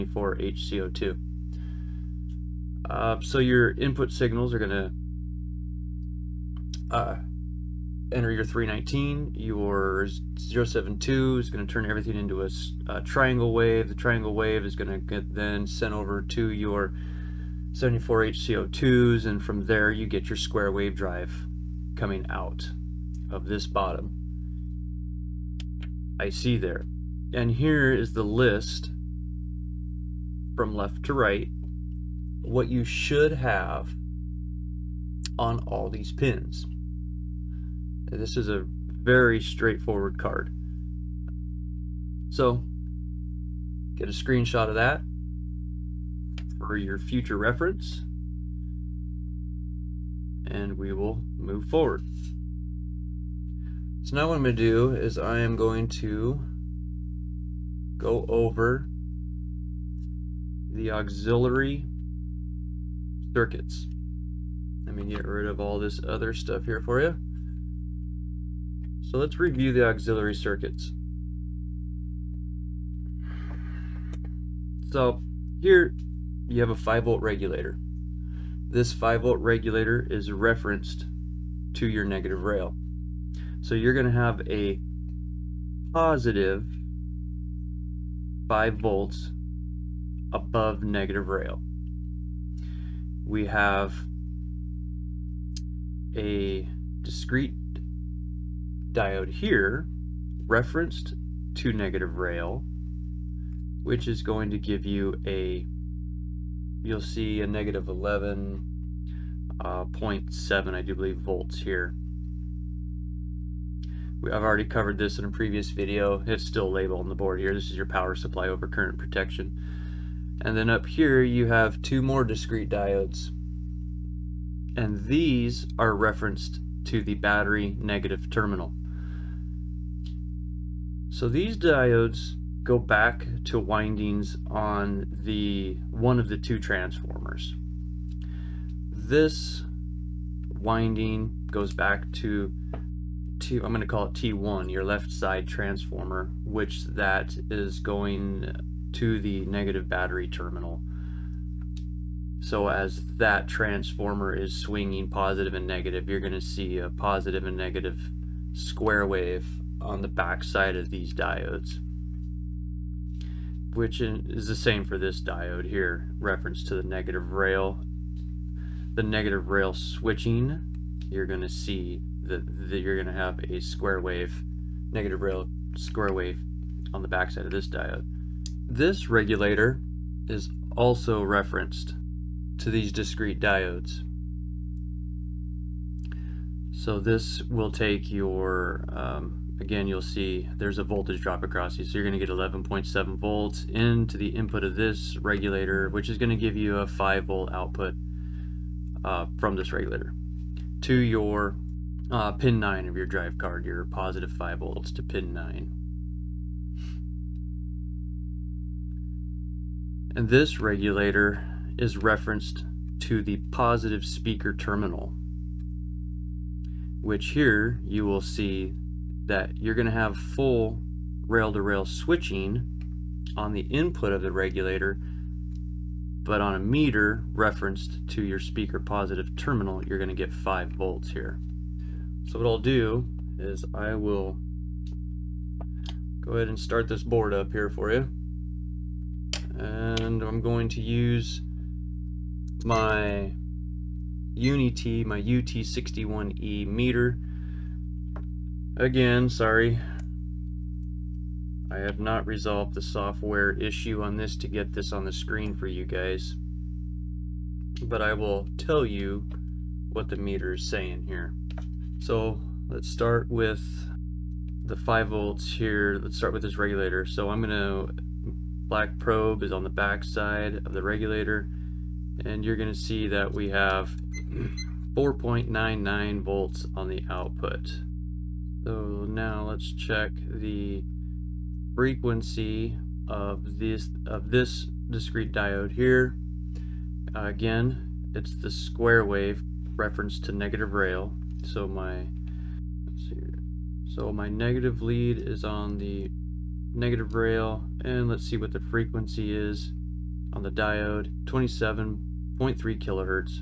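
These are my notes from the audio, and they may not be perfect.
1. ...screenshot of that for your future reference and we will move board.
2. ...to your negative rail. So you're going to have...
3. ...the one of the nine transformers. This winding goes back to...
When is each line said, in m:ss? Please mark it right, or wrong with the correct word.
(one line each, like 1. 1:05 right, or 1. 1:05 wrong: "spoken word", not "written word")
1. 0:44 wrong: "forward", not "board"
2. 1:21 right
3. 2:15 wrong: "two", not "nine".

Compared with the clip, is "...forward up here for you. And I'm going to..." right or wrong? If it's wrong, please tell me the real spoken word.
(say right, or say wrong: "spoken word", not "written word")
wrong: "board", not "forward".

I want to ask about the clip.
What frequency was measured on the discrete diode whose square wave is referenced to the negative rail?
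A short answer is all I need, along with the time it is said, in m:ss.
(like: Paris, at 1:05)
27.3 kHz, at 5:01.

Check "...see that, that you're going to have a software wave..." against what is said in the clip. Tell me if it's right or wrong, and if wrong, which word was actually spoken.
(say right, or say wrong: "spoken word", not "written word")
wrong: "square", not "software".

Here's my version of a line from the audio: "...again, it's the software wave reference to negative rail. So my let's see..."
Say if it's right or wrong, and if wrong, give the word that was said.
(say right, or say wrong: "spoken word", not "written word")
wrong: "square", not "software".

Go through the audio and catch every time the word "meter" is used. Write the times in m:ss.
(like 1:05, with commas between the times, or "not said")
3:46, 4:06, 4:20.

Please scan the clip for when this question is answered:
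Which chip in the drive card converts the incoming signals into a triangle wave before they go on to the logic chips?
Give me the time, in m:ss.
0:10.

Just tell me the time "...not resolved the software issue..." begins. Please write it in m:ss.
4:11.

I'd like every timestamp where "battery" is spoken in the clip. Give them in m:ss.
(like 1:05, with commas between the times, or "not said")
2:07, 2:29.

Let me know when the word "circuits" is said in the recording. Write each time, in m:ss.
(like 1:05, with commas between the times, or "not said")
1:03, 1:10.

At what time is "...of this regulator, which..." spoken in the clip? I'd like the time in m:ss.
3:14.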